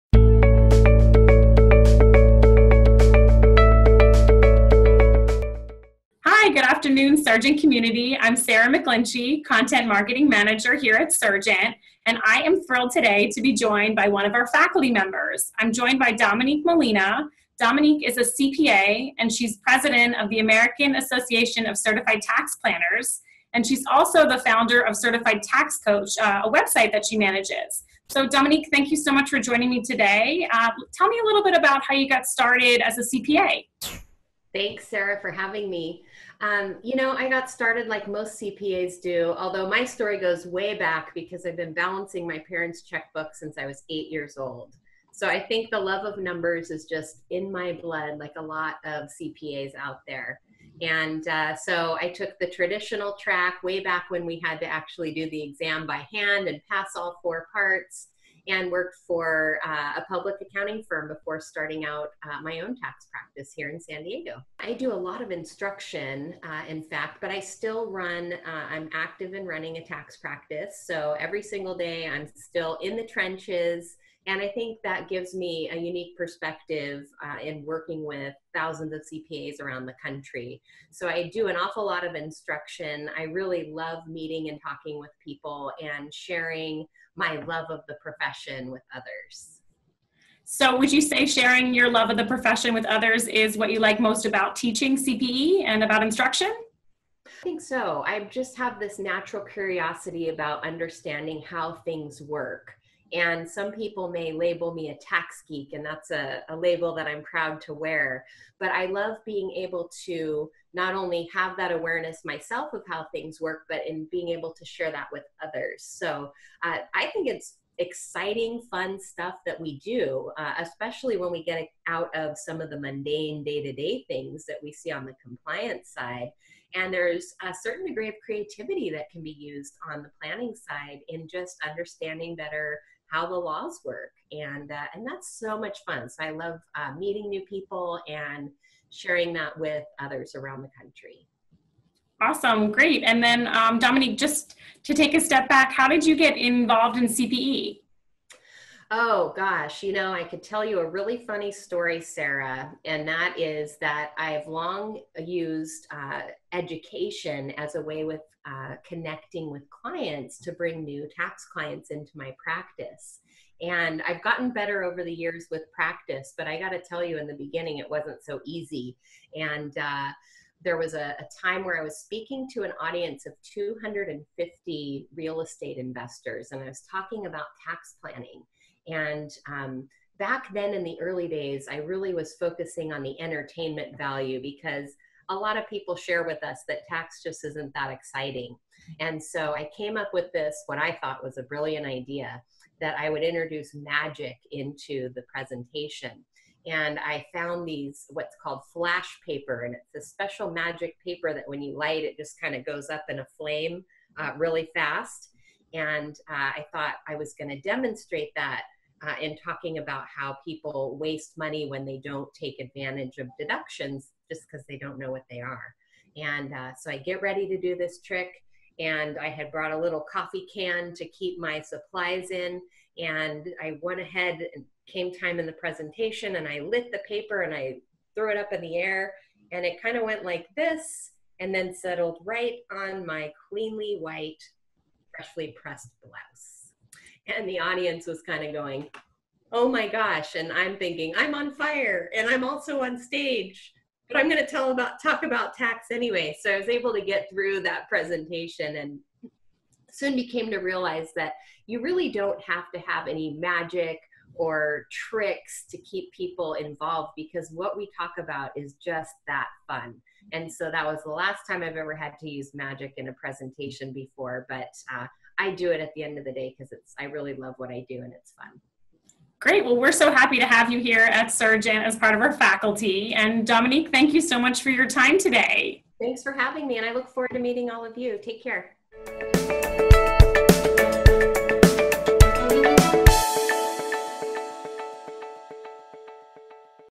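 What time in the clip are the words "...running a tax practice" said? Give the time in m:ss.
1:09.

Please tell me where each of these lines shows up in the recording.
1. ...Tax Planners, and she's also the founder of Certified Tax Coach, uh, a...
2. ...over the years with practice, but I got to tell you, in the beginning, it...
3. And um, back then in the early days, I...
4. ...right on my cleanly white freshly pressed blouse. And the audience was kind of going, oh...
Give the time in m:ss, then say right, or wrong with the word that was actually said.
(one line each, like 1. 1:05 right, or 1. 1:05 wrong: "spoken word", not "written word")
1. 0:22 right
2. 2:44 right
3. 2:58 right
4. 3:52 right.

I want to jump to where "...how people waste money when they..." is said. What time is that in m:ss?
3:30.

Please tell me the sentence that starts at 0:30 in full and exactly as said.
Uh, tell me a little bit about how you got started as a CPA.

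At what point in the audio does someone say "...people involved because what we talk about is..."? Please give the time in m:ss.
4:16.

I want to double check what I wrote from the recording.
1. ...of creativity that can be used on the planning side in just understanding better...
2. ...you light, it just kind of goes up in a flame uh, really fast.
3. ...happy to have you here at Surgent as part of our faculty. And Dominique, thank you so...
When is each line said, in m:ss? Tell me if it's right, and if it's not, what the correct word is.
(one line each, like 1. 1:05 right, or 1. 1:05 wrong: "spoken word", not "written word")
1. 2:08 right
2. 3:21 right
3. 4:30 right.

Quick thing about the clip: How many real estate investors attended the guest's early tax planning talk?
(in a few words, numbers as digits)
250.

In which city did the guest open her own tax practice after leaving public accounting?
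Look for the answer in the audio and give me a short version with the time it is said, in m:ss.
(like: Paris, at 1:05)
San Diego, at 1:03.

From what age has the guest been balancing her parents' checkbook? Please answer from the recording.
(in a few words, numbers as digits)
8.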